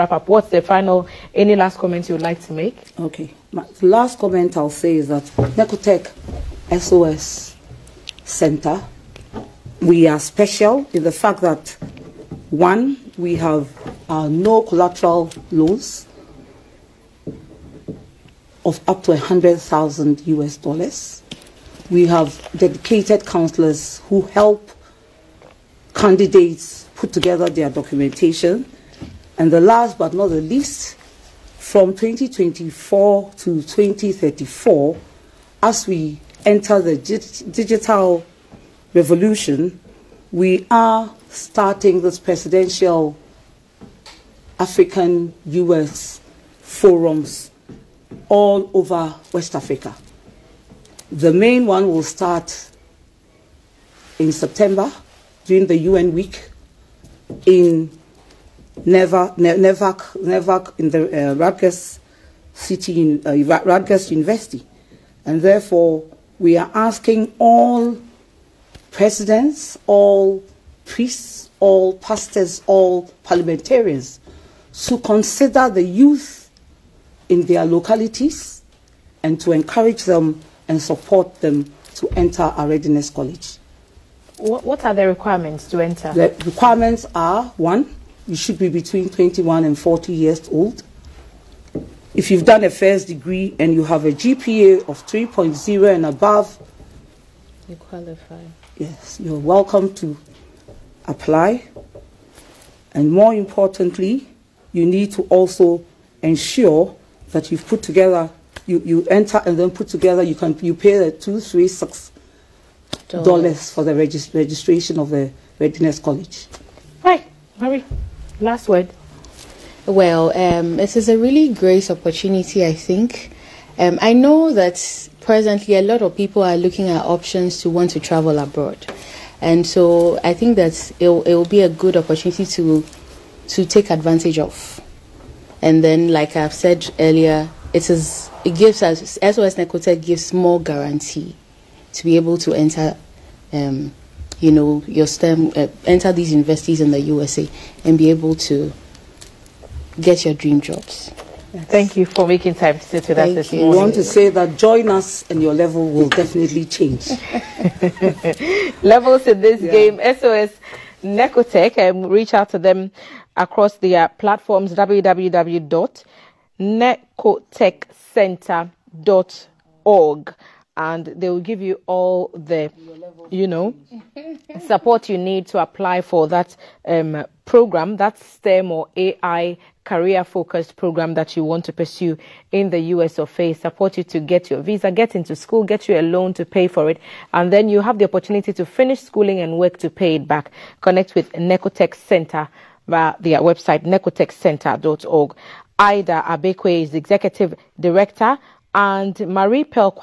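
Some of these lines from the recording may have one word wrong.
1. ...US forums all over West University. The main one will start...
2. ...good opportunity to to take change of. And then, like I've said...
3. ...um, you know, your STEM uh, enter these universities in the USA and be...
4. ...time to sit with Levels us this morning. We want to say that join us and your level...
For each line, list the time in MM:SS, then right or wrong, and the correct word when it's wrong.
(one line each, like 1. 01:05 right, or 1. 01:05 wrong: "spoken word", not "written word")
1. 00:45 wrong: "Africa", not "University"
2. 02:11 wrong: "advantage", not "change"
3. 02:23 right
4. 02:32 wrong: "Thank", not "Levels".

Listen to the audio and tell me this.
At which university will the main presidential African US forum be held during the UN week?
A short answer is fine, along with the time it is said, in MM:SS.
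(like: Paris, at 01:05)
Rutgers University, at 01:03.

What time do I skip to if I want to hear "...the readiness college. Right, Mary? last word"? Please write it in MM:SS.
01:55.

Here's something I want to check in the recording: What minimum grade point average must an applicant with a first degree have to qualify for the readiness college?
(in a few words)
3.0.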